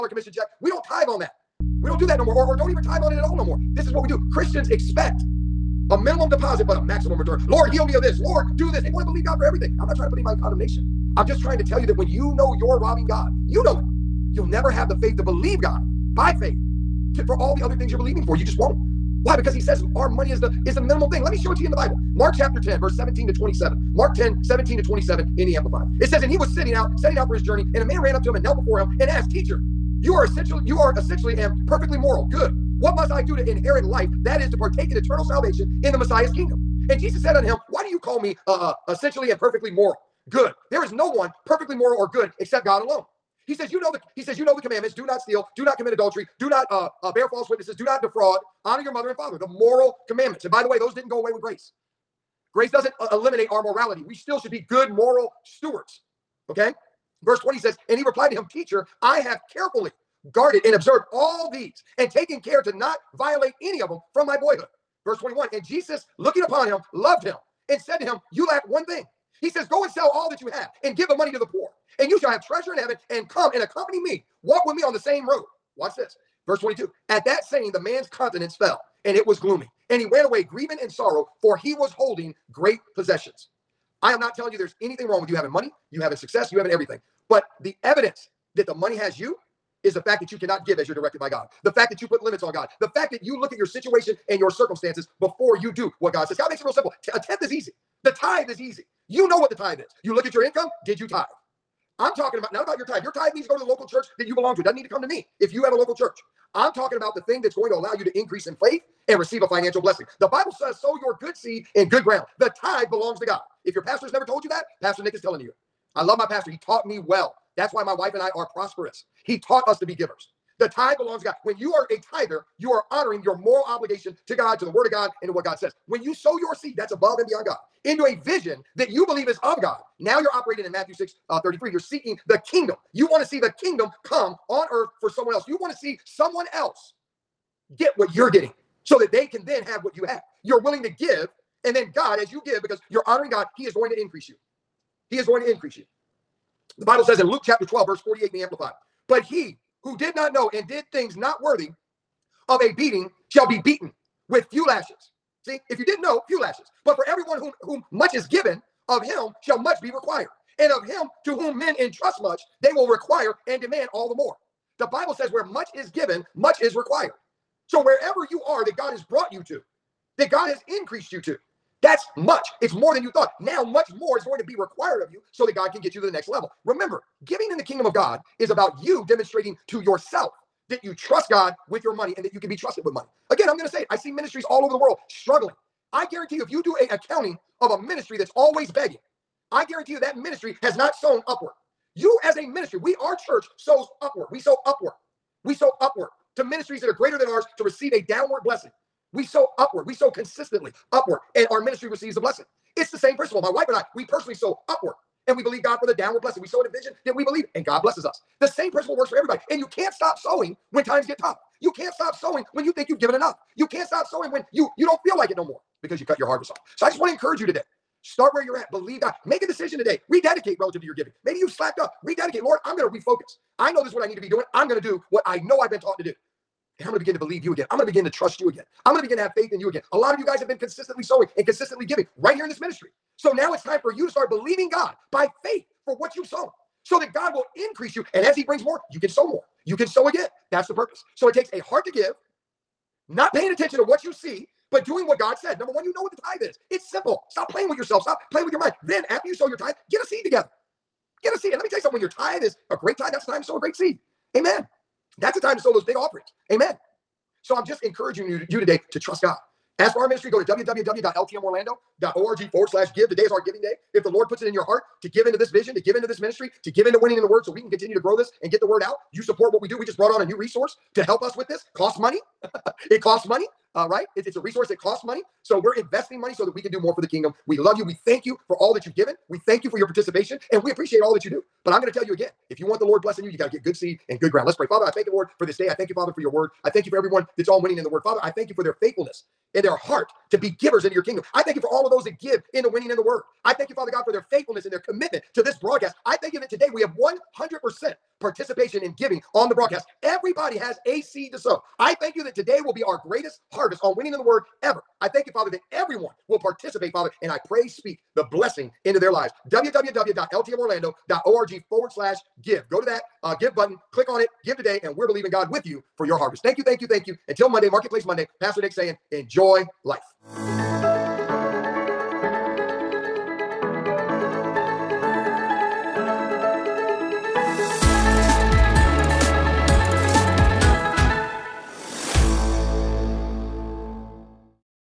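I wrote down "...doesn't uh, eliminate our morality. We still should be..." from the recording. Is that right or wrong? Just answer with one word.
right.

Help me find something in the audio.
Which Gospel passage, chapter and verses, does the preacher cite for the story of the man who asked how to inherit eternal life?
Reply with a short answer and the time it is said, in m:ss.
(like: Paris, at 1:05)
Mark 10:17-27, at 0:22.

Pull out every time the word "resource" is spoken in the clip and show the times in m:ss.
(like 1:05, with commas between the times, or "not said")
4:30, 4:34.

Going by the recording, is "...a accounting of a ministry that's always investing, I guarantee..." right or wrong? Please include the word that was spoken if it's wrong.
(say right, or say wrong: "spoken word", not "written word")
wrong: "begging", not "investing".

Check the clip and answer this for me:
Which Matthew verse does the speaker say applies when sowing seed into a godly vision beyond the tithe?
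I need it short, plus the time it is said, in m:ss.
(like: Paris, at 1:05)
Matthew 6:33, at 2:10.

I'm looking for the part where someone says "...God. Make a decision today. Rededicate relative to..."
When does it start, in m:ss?
3:39.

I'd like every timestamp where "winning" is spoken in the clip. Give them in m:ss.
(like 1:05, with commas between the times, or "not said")
4:27, 4:47, 4:52, 5:03.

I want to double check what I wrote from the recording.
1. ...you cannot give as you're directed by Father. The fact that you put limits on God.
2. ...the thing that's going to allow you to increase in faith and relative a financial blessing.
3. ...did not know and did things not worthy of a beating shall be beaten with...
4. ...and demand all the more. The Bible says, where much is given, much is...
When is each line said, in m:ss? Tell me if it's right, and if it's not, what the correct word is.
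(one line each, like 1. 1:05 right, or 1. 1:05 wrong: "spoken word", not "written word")
1. 1:30 wrong: "God", not "Father"
2. 1:47 wrong: "receive", not "relative"
3. 2:29 right
4. 2:43 right.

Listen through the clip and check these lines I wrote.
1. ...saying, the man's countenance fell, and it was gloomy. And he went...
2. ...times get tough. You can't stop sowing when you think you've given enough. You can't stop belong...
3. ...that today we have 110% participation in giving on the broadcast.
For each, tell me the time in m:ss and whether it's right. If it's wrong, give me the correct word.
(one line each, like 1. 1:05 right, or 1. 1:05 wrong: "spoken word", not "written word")
1. 1:17 right
2. 3:30 wrong: "sowing", not "belong"
3. 4:56 wrong: "100", not "110".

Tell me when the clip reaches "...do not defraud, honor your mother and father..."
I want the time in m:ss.
0:47.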